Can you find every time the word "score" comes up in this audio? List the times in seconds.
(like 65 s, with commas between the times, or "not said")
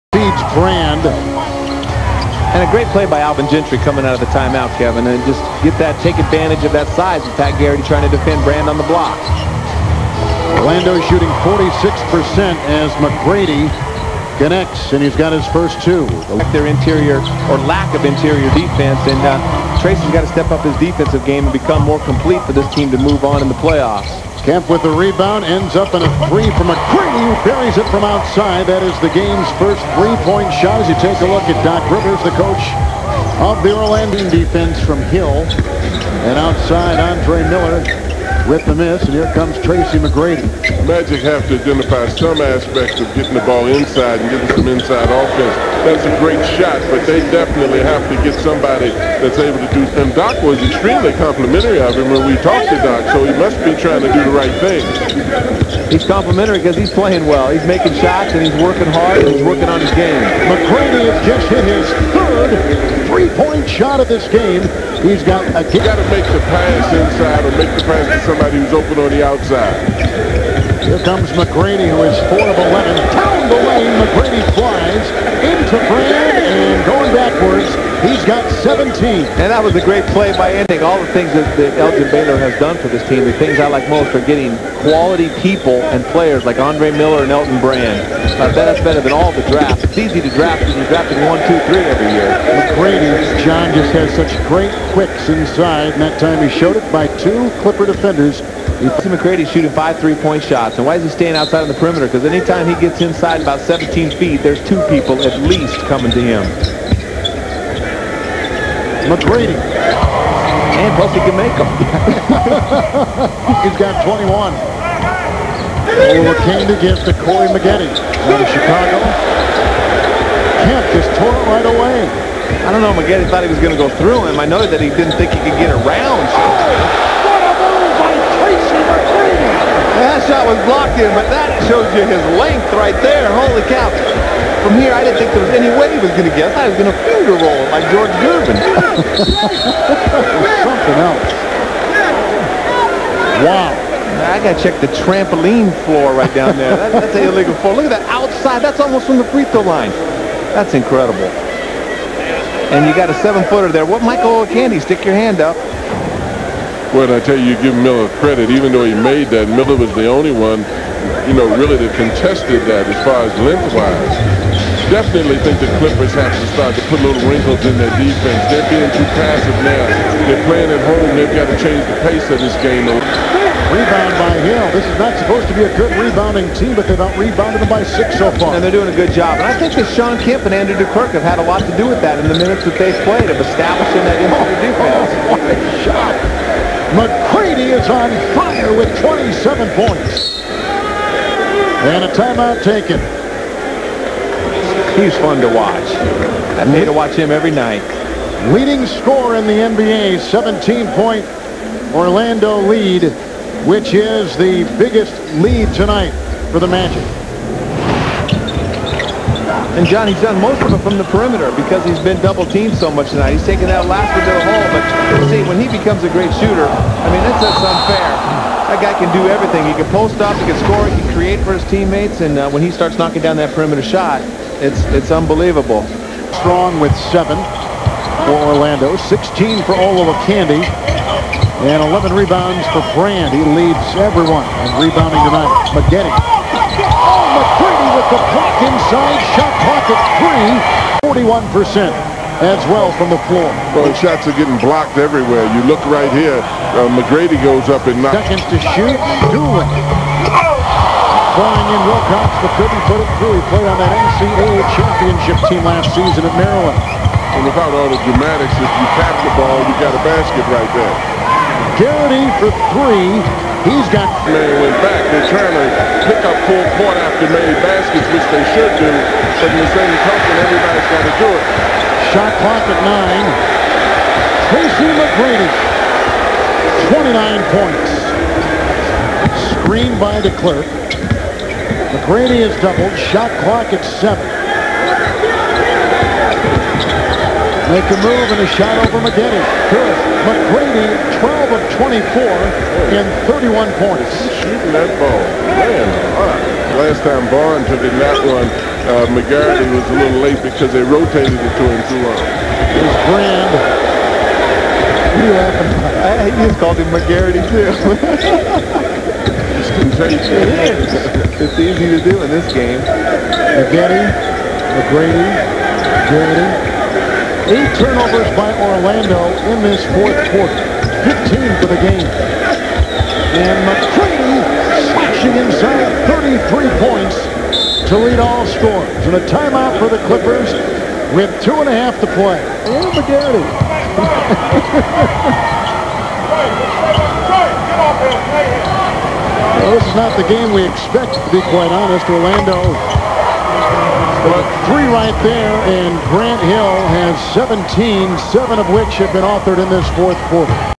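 198 s, 220 s, 328 s.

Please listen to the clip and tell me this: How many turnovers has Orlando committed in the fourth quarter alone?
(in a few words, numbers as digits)
8.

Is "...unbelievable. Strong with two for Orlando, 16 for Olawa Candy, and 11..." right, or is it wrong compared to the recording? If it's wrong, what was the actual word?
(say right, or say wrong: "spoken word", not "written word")
wrong: "seven", not "two".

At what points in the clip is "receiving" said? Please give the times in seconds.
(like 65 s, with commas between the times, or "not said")
not said.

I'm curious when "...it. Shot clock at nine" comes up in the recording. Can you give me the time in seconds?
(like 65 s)
271 s.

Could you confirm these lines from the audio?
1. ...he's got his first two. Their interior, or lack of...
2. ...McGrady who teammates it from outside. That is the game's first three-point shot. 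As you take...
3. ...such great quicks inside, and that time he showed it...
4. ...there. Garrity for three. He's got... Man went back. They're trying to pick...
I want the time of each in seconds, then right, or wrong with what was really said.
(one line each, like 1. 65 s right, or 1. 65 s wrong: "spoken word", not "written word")
1. 15 s right
2. 26 s wrong: "buries", not "teammates"
3. 94 s right
4. 260 s right.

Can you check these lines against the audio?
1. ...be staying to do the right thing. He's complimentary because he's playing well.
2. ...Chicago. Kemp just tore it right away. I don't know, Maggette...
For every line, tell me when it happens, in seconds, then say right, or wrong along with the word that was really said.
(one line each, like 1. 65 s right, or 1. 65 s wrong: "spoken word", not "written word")
1. 53 s wrong: "trying", not "staying"
2. 118 s right.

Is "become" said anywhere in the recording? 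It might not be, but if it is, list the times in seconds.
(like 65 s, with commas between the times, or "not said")
21 s, 215 s.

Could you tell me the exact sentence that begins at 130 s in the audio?
shot was blocked in, but that shows you his length right there.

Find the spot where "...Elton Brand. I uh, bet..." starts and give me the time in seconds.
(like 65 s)
87 s.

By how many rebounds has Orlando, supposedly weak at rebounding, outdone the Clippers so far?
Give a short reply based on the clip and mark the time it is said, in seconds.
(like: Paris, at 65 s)
6, at 177 s.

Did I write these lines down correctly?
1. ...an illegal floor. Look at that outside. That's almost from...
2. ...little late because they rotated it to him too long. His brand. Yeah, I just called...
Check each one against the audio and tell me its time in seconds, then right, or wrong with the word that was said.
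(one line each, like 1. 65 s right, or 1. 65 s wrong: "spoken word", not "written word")
1. 147 s right
2. 299 s right.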